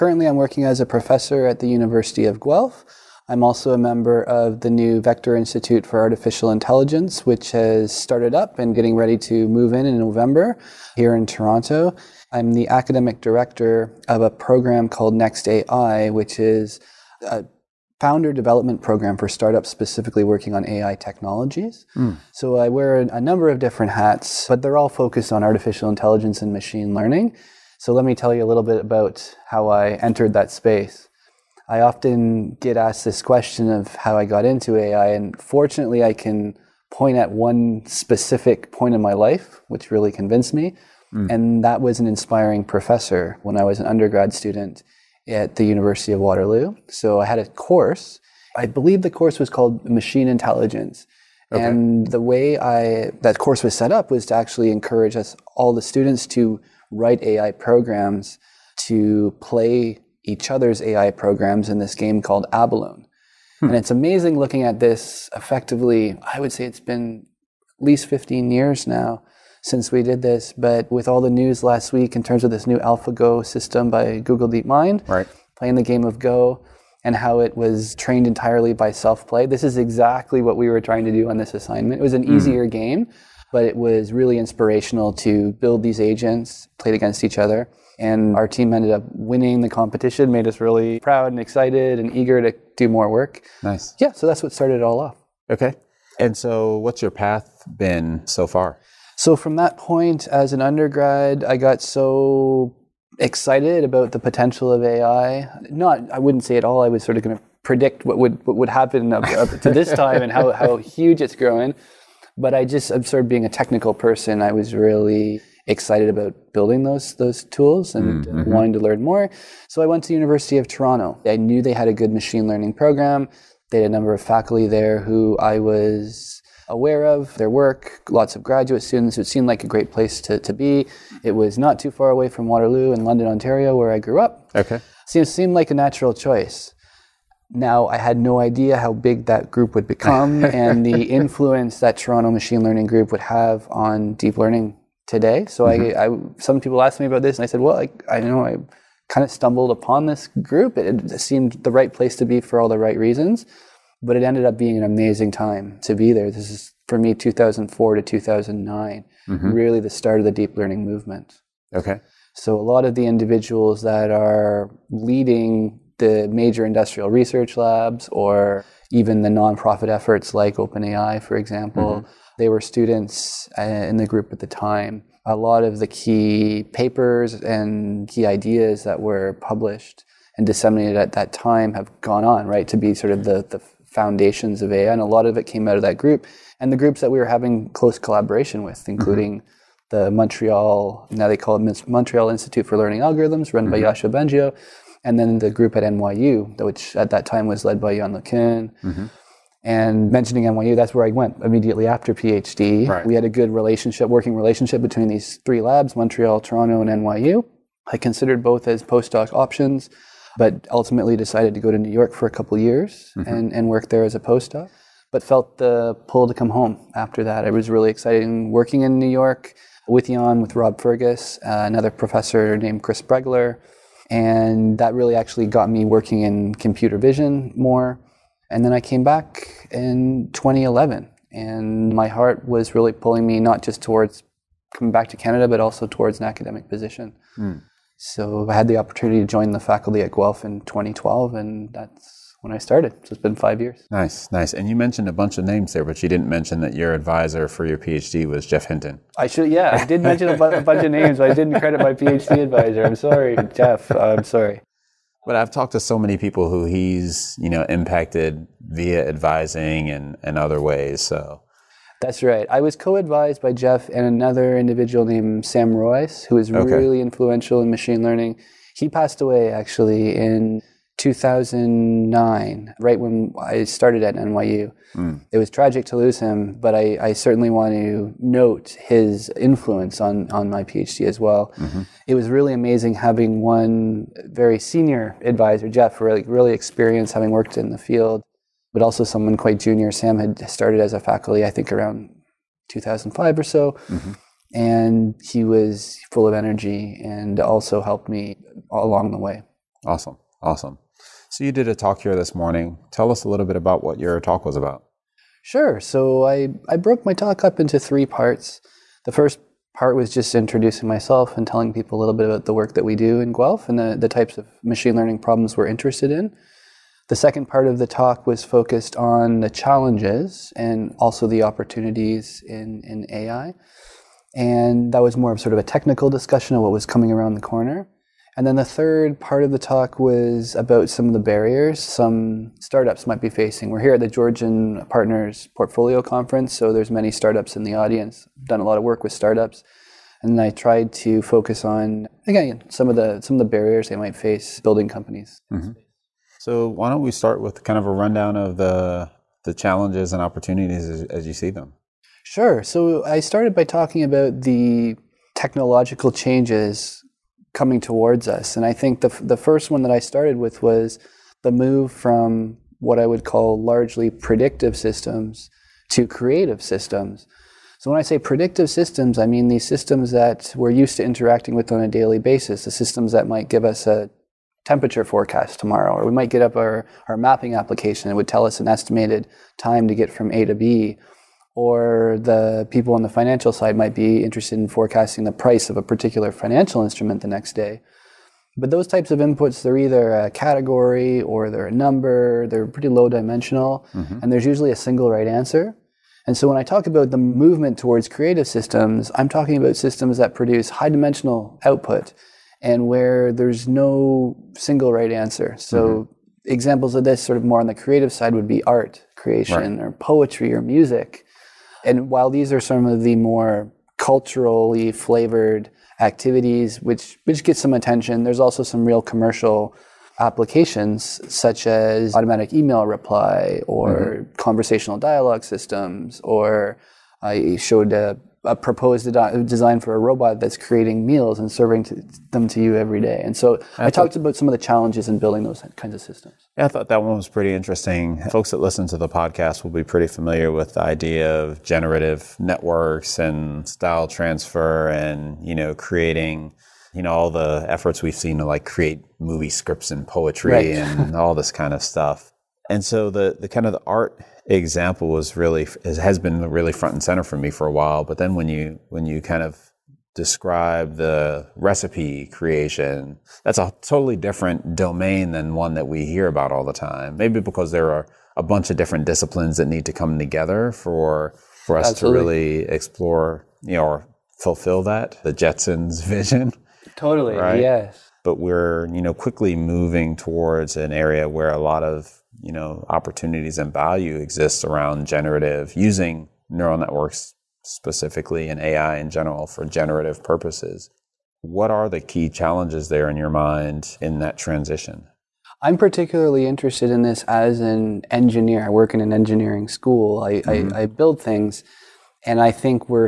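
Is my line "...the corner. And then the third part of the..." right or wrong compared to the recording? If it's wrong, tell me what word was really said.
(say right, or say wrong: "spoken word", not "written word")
right.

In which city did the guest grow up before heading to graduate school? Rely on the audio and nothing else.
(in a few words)
London, Ontario.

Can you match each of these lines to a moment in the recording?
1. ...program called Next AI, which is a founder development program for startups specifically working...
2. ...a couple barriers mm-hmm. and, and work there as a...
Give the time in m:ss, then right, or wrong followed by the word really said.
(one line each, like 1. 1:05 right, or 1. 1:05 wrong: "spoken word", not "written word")
1. 0:14 right
2. 3:32 wrong: "years", not "barriers".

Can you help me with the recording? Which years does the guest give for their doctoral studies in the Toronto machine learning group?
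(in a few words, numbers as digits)
2004 to 2009.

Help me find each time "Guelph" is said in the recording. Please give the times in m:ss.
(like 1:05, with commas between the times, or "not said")
0:02, 4:00, 5:13.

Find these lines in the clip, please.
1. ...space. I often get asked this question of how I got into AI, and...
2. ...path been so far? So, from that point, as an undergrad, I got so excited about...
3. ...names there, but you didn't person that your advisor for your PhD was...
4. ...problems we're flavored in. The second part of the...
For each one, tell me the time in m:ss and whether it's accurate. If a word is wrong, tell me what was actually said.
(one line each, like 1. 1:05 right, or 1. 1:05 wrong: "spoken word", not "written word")
1. 0:30 right
2. 1:37 right
3. 4:05 wrong: "mention", not "person"
4. 5:15 wrong: "interested", not "flavored".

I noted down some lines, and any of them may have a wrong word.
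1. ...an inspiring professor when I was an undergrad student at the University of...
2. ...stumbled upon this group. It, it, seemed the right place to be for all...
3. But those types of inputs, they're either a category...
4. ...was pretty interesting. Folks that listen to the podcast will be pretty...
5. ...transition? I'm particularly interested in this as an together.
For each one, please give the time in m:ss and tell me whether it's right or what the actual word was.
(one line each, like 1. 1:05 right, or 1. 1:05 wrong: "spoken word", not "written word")
1. 0:41 right
2. 2:29 right
3. 6:28 right
4. 7:17 right
5. 8:14 wrong: "engineer", not "together".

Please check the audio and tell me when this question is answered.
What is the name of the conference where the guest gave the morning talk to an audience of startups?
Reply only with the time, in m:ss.
5:34.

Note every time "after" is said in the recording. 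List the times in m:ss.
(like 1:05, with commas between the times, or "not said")
3:21, 3:36.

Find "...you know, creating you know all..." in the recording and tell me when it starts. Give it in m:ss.
7:25.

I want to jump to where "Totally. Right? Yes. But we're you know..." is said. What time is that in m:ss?
7:56.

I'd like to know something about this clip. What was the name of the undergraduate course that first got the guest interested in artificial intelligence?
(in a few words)
Machine Intelligence.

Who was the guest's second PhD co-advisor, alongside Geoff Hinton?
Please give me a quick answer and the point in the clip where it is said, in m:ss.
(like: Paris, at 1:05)
Sam Roweis, at 4:25.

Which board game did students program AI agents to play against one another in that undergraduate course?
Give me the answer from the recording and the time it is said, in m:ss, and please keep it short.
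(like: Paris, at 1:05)
Abalone, at 1:02.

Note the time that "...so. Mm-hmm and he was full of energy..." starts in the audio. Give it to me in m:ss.
4:53.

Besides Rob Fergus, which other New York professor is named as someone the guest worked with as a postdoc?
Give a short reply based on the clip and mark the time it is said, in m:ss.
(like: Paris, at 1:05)
Chris Bregler, at 3:42.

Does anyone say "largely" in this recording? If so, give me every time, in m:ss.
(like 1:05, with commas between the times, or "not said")
6:03.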